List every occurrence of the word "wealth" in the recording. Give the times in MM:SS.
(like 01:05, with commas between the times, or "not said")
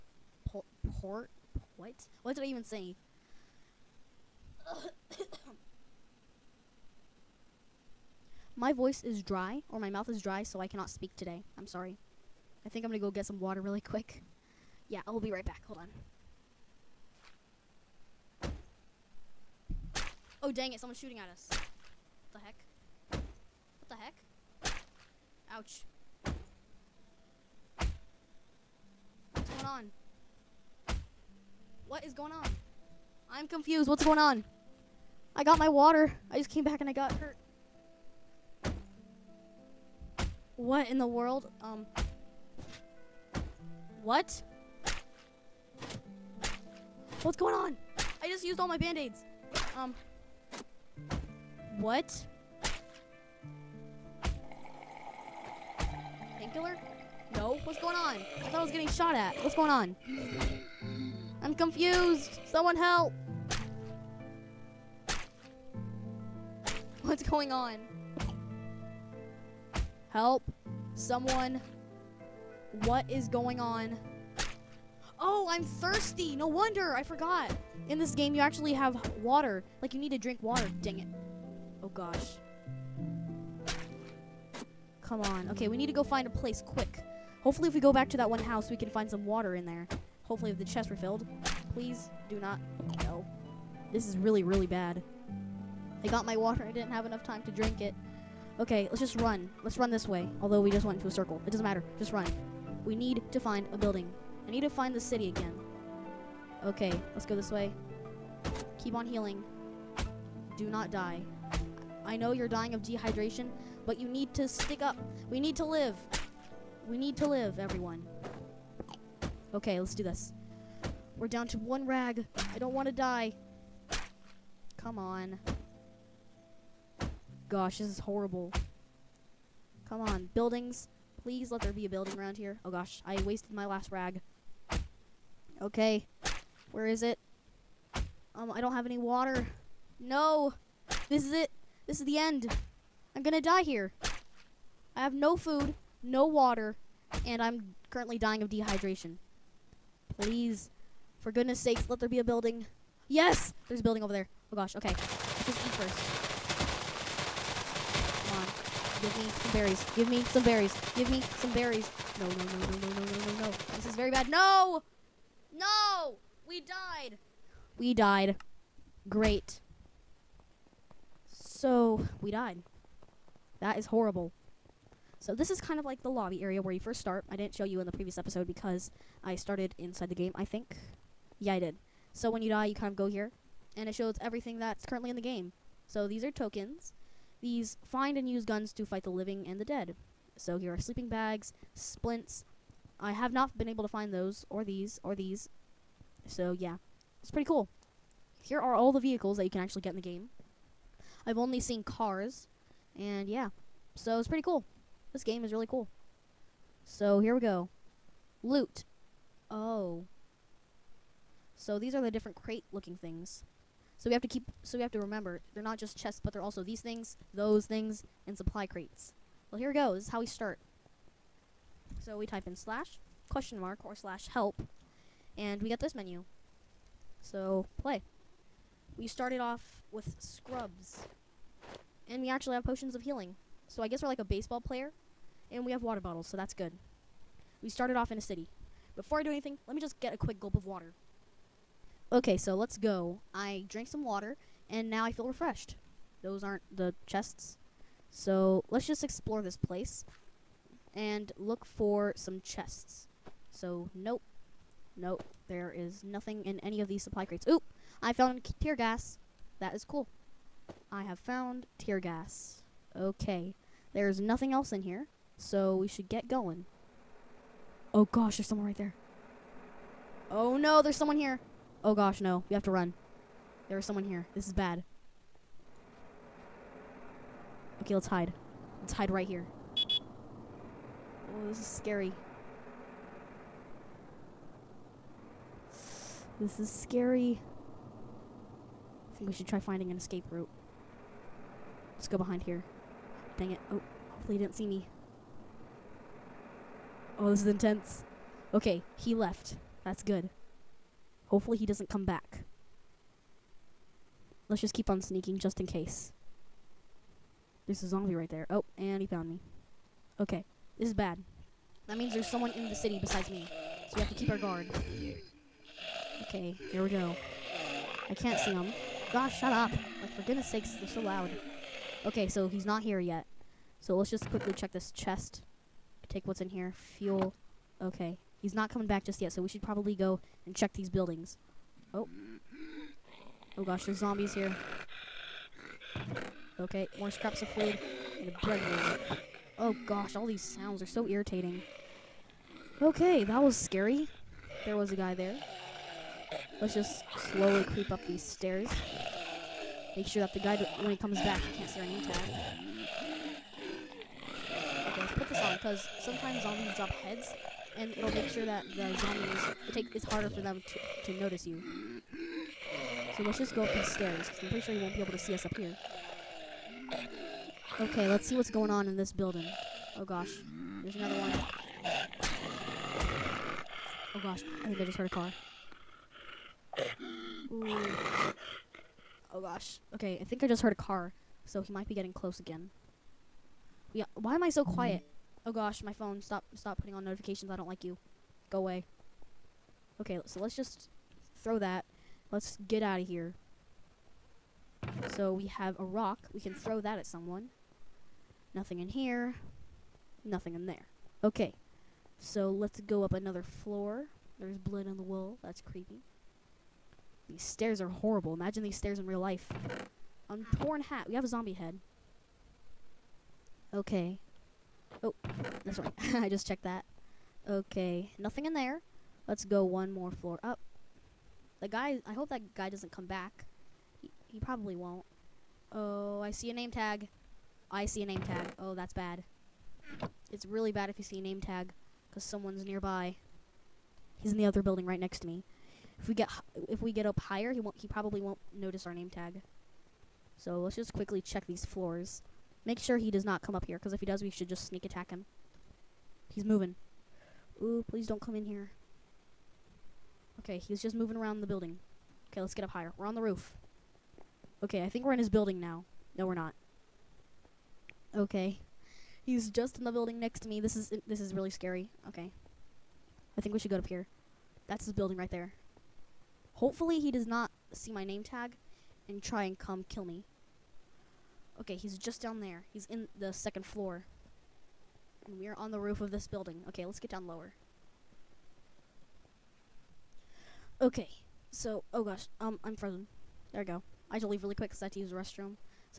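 not said.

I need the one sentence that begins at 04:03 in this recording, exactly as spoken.
I drank some water, and now I feel refreshed.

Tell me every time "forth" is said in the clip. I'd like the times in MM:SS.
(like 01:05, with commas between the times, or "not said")
not said.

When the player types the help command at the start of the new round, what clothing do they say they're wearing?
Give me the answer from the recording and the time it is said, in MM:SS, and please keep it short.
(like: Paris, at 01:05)
Scrubs, at 03:50.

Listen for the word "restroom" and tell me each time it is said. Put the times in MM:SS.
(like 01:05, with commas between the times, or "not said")
08:05.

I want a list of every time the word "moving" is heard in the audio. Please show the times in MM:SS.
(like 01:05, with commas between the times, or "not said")
07:26, 07:30.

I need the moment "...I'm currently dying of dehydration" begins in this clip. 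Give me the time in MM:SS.
02:27.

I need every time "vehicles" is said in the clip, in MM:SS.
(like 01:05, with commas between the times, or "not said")
03:18.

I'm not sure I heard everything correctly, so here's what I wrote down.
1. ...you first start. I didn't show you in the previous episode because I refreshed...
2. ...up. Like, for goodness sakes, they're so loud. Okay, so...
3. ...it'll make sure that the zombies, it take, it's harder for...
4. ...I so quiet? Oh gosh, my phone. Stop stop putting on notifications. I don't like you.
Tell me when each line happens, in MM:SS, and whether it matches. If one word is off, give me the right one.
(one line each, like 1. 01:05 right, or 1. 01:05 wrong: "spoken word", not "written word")
1. 02:56 wrong: "started", not "refreshed"
2. 05:19 right
3. 05:57 right
4. 06:24 right.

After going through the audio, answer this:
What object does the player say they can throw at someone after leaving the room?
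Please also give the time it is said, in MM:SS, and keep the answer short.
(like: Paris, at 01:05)
A rock, at 06:35.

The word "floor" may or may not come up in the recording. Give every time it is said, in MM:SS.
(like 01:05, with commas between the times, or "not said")
06:43, 07:00, 07:21, 07:53.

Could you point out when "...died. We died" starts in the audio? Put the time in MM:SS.
02:46.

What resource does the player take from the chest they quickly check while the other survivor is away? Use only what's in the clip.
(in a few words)
Fuel.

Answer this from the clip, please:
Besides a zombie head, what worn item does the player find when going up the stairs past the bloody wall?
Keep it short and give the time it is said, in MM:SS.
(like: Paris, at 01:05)
Torn hat, at 06:50.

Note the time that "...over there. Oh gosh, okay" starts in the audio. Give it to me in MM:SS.
02:34.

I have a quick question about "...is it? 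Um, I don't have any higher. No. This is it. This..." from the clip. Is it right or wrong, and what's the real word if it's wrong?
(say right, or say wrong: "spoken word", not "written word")
wrong: "water", not "higher".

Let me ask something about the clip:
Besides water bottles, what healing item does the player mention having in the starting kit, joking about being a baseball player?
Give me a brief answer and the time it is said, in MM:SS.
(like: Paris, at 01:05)
Potions of healing, at 03:52.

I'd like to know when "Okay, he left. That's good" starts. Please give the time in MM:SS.
04:58.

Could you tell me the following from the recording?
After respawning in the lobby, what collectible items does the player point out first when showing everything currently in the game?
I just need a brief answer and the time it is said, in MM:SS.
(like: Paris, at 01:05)
Tokens, at 03:06.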